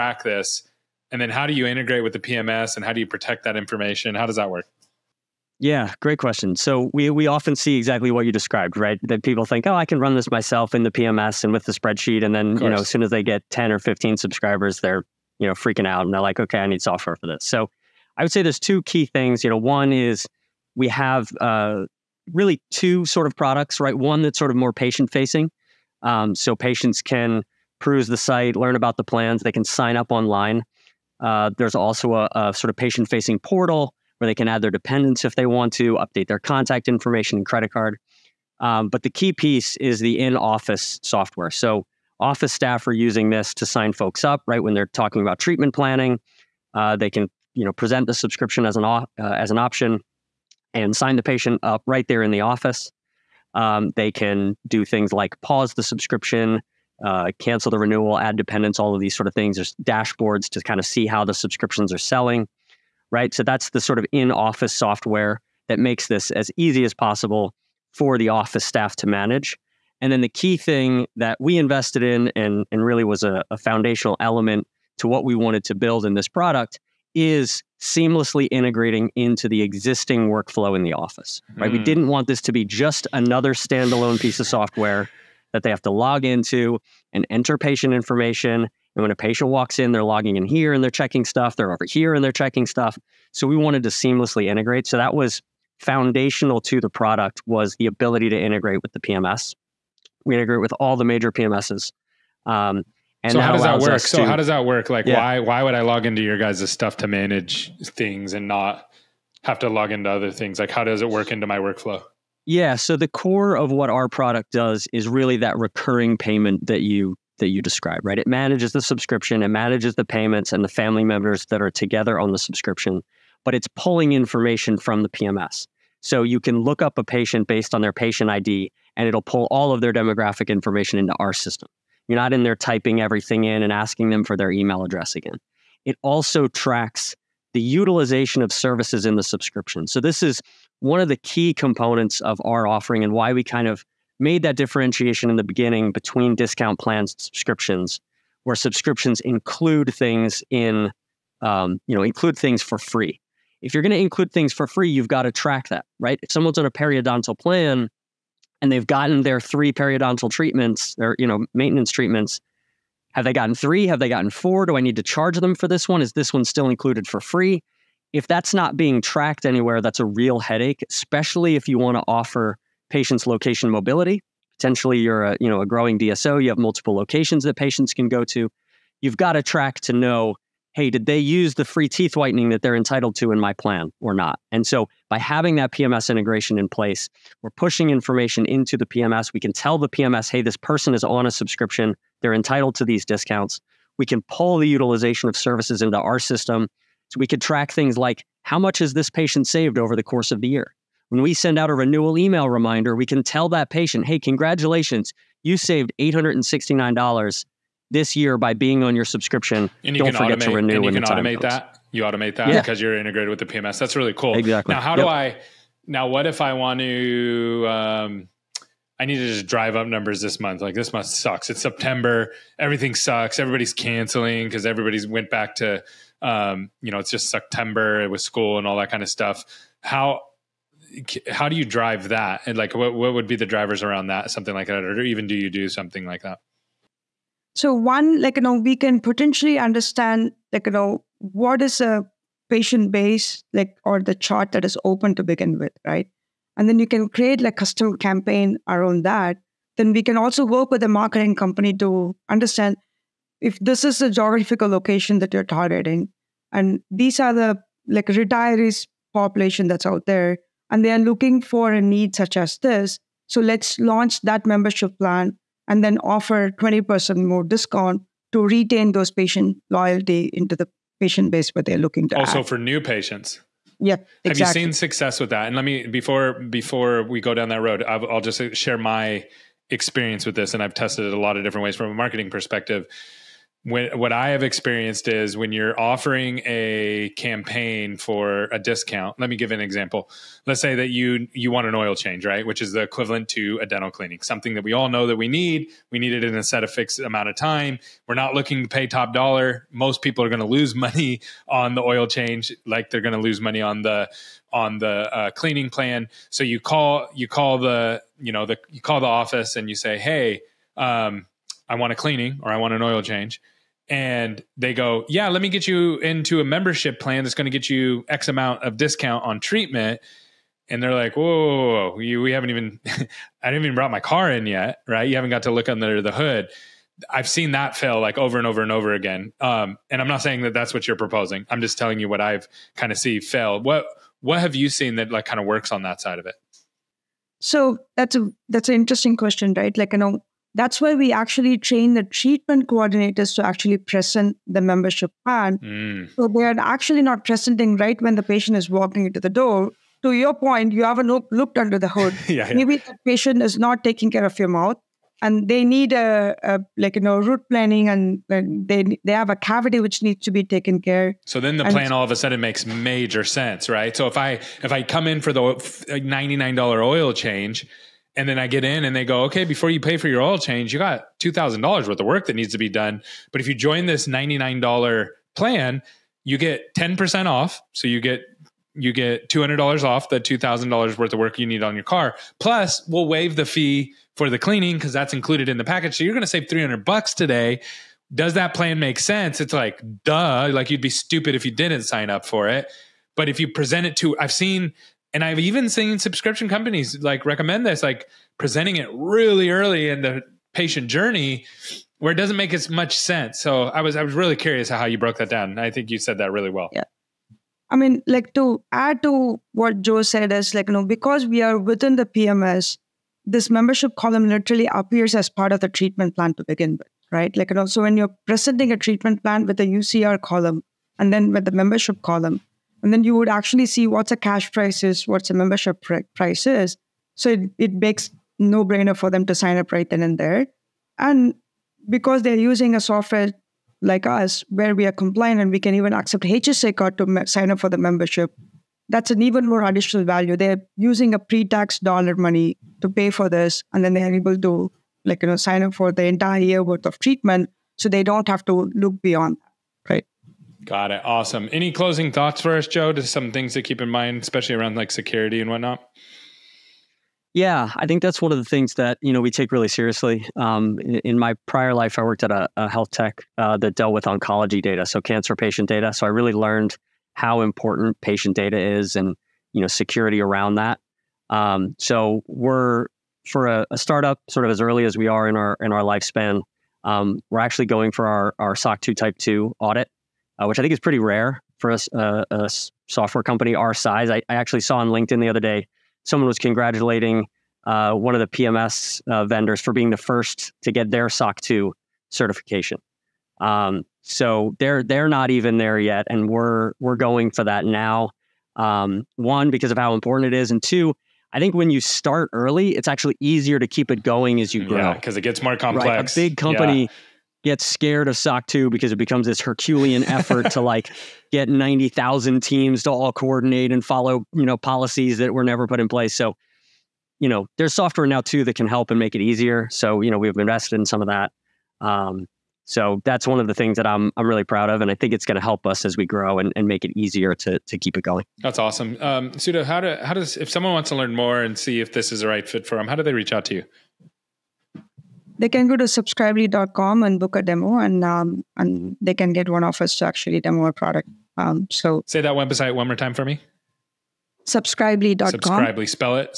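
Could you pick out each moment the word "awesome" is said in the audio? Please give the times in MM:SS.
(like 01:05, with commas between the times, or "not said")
07:31, 08:48.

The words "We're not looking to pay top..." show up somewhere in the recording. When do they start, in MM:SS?
04:58.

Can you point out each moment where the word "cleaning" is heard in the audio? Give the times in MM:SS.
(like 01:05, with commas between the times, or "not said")
04:53, 05:05, 05:11, 06:24.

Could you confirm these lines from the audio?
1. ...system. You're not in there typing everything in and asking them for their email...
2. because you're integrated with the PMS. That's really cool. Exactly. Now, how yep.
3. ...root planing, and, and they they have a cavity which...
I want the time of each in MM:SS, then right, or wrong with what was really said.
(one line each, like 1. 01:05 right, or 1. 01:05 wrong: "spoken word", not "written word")
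1. 02:11 right
2. 03:32 right
3. 05:57 right.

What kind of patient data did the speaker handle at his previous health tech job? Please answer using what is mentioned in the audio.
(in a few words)
oncology data.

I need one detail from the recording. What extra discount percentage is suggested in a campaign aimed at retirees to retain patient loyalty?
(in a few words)
20%.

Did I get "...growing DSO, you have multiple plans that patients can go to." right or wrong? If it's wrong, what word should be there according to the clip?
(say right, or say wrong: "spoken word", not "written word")
wrong: "locations", not "plans".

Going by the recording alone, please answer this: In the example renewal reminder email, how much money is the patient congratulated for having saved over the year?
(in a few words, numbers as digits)
$869.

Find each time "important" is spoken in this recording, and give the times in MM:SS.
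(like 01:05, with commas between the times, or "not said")
07:47, 08:19.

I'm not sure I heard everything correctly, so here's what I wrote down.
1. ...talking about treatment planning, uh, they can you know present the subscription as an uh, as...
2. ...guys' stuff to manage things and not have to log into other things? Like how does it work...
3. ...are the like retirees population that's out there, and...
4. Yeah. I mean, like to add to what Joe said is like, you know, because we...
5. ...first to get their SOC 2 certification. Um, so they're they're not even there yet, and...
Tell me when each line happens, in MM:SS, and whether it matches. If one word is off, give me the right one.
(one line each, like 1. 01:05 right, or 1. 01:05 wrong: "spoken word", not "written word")
1. 00:44 right
2. 01:46 right
3. 04:17 right
4. 06:46 right
5. 08:09 right.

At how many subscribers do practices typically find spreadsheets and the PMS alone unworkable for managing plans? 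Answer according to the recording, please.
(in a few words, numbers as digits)
10 or 15.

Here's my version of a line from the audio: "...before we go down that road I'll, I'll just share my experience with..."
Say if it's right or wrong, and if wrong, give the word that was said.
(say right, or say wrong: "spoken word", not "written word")
right.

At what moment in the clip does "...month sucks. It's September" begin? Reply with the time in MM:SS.
03:40.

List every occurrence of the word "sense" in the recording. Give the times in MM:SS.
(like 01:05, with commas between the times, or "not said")
06:03, 06:28, 06:42.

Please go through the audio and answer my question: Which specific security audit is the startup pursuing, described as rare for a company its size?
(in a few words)
SOC 2 Type 2.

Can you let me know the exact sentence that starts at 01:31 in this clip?
They're over here and they're checking stuff.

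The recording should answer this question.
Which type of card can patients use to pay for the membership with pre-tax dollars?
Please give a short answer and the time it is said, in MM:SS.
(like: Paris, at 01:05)
HSA card, at 07:16.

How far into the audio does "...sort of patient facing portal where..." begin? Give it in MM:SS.
00:32.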